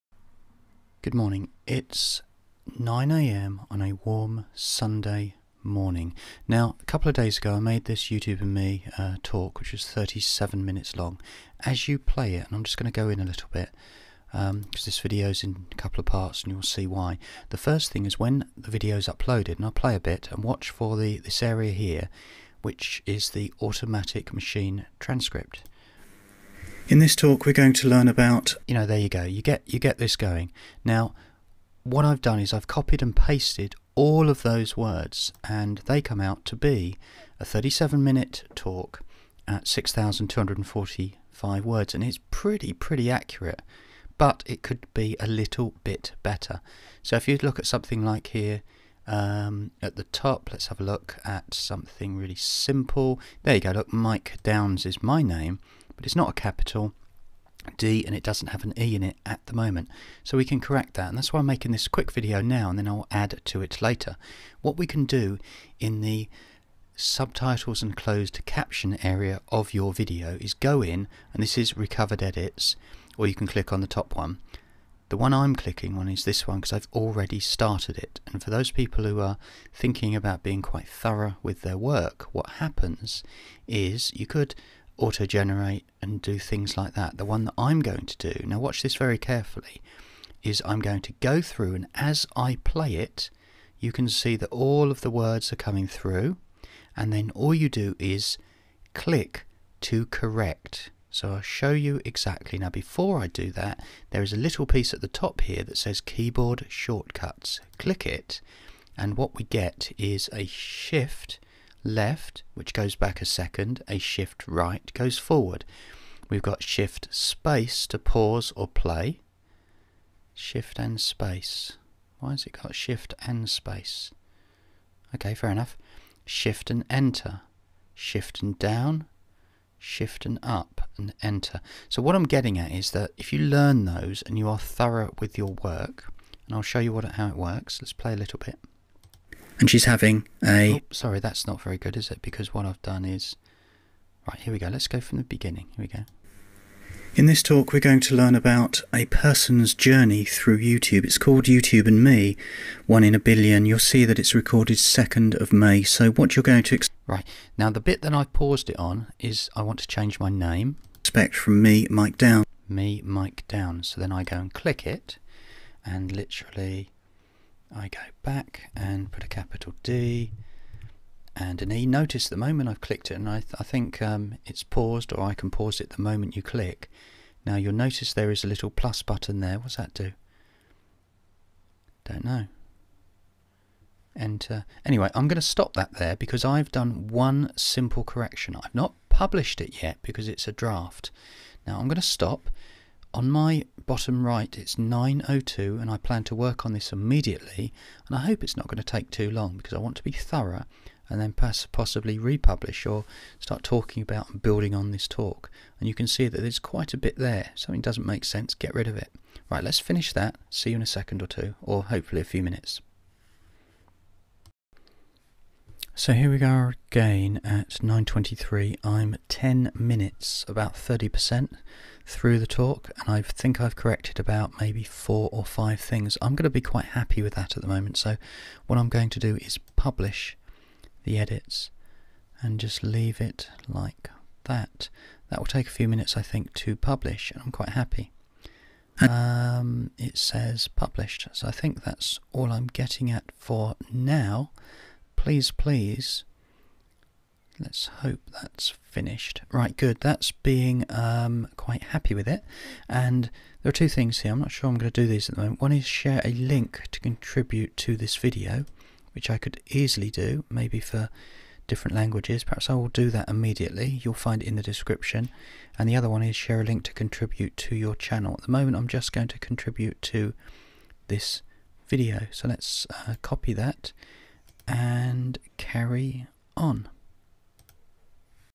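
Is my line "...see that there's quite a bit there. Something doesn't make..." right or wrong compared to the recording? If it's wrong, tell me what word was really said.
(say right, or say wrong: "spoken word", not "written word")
right.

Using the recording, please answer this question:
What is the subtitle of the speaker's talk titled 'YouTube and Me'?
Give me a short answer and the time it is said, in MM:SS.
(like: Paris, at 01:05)
One in a Billion, at 02:32.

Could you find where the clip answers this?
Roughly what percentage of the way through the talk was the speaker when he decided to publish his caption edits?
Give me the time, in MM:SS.
03:40.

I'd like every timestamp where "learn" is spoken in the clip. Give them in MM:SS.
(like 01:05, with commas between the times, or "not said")
00:27, 02:13, 02:28.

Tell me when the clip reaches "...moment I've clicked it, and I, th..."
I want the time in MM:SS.
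02:52.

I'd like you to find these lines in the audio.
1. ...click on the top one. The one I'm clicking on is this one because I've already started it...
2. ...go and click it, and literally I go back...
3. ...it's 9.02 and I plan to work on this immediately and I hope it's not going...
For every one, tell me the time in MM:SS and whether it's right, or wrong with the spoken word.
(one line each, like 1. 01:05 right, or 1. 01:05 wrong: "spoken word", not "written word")
1. 01:13 right
2. 02:44 right
3. 03:14 right.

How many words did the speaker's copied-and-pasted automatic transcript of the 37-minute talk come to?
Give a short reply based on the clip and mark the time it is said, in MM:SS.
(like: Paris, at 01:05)
6245, at 00:39.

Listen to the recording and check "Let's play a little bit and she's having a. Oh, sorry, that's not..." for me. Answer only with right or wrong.
right.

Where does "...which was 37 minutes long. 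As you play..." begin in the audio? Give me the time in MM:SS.
00:09.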